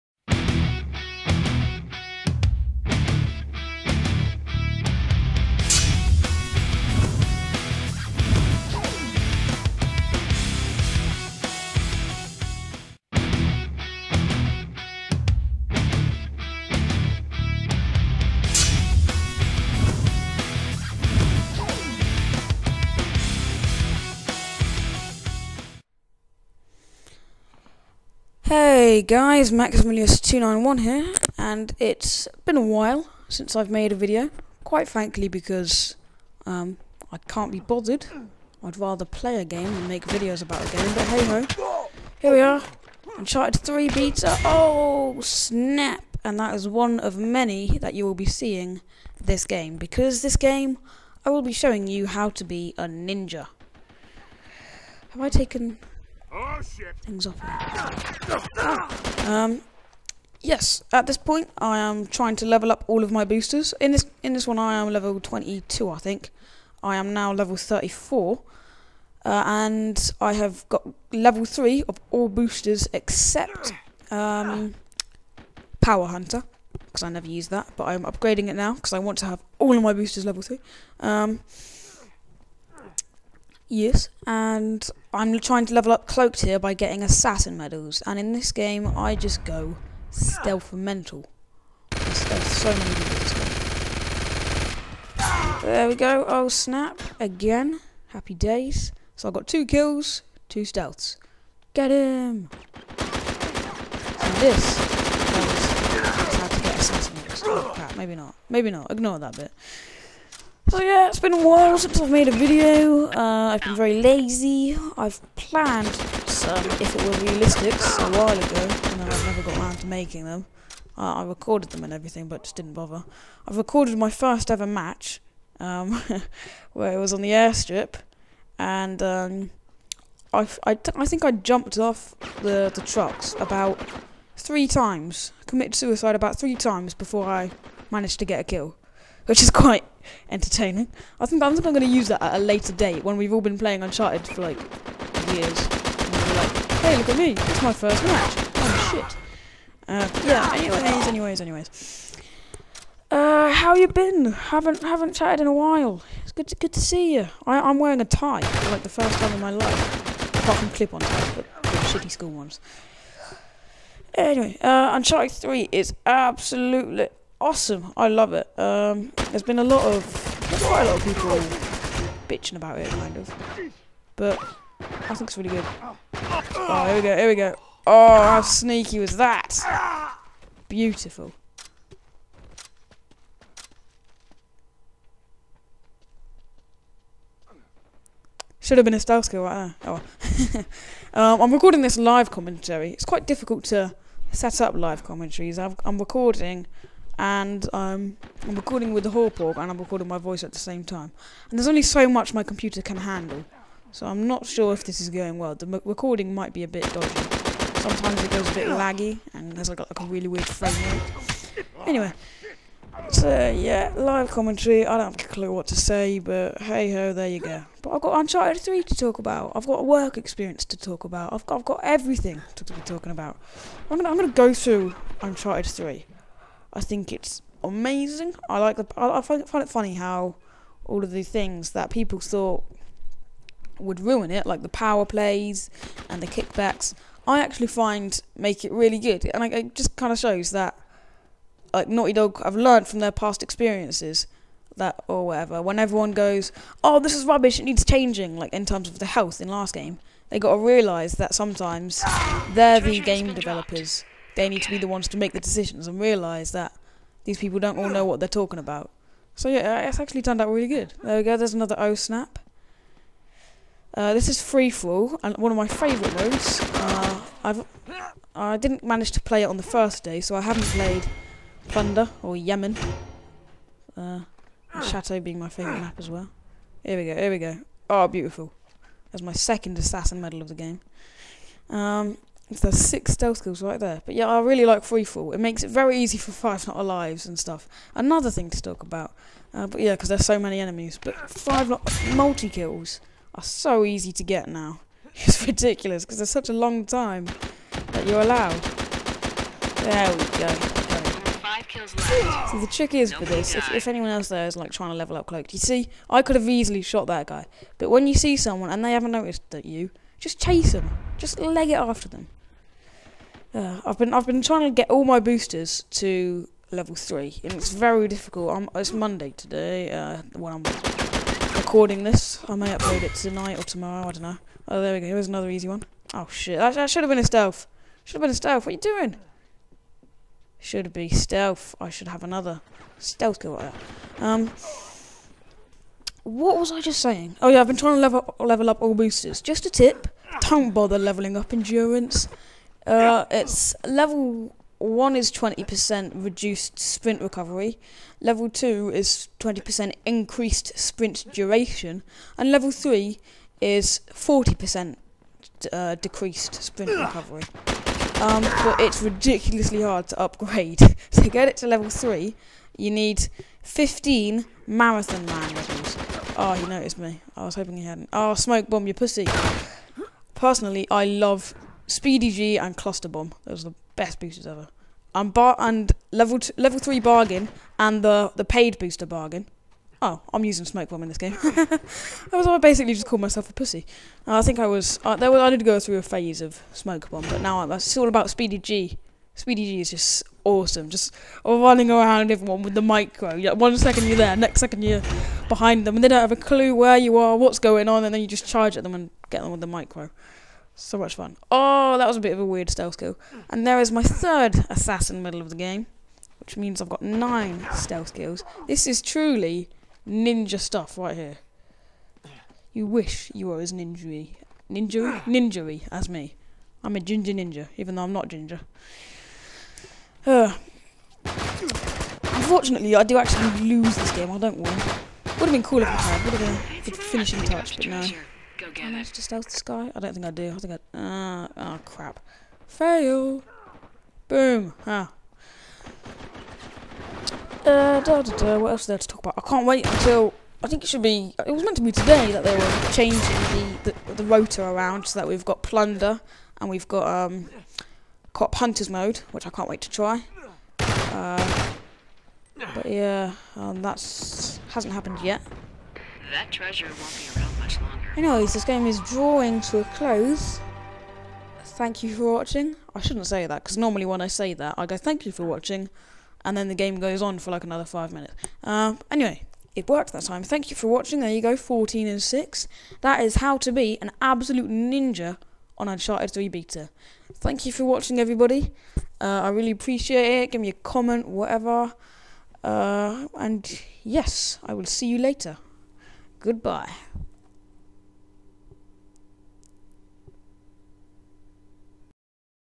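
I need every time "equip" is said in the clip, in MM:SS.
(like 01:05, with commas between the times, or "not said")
not said.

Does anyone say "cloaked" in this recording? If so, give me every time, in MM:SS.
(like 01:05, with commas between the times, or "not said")
01:26, 05:05.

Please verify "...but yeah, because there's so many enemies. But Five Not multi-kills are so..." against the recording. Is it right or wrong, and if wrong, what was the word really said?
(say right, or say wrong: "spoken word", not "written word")
right.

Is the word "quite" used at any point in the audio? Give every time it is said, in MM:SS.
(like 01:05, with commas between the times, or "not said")
00:34, 02:19, 02:50, 03:13.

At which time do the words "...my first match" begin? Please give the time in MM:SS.
02:27.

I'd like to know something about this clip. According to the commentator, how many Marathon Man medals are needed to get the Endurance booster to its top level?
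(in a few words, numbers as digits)
15.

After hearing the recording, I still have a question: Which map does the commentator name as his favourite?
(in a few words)
Chateau.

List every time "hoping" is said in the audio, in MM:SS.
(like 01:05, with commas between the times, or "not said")
06:07.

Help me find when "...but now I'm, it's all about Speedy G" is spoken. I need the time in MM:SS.
06:27.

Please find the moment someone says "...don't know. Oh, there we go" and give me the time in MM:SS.
05:24.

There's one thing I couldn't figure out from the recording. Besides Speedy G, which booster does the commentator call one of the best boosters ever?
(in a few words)
Cluster Bomb.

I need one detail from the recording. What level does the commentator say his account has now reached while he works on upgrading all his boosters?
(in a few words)
34.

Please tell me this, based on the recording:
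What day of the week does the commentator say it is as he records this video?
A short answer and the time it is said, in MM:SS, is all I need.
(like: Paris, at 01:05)
Monday, at 05:18.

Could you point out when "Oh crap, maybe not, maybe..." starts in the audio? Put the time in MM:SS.
01:47.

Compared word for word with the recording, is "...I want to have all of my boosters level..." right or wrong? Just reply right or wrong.
right.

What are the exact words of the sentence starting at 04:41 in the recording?
Um, so there's six stealth skills right there.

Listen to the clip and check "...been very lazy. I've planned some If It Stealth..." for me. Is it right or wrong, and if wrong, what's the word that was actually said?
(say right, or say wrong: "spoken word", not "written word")
wrong: "Were", not "Stealth".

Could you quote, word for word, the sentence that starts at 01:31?
I stealth so many this game.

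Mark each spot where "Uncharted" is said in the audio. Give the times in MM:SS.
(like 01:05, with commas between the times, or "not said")
00:43, 02:23, 02:44, 03:38, 03:45, 07:55.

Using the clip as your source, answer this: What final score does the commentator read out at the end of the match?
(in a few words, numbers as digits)
14 and 6.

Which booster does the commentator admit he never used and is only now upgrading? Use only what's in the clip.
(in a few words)
Power Hunter.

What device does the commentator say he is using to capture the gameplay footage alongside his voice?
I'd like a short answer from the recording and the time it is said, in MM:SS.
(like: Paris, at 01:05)
Hauppauge, at 03:19.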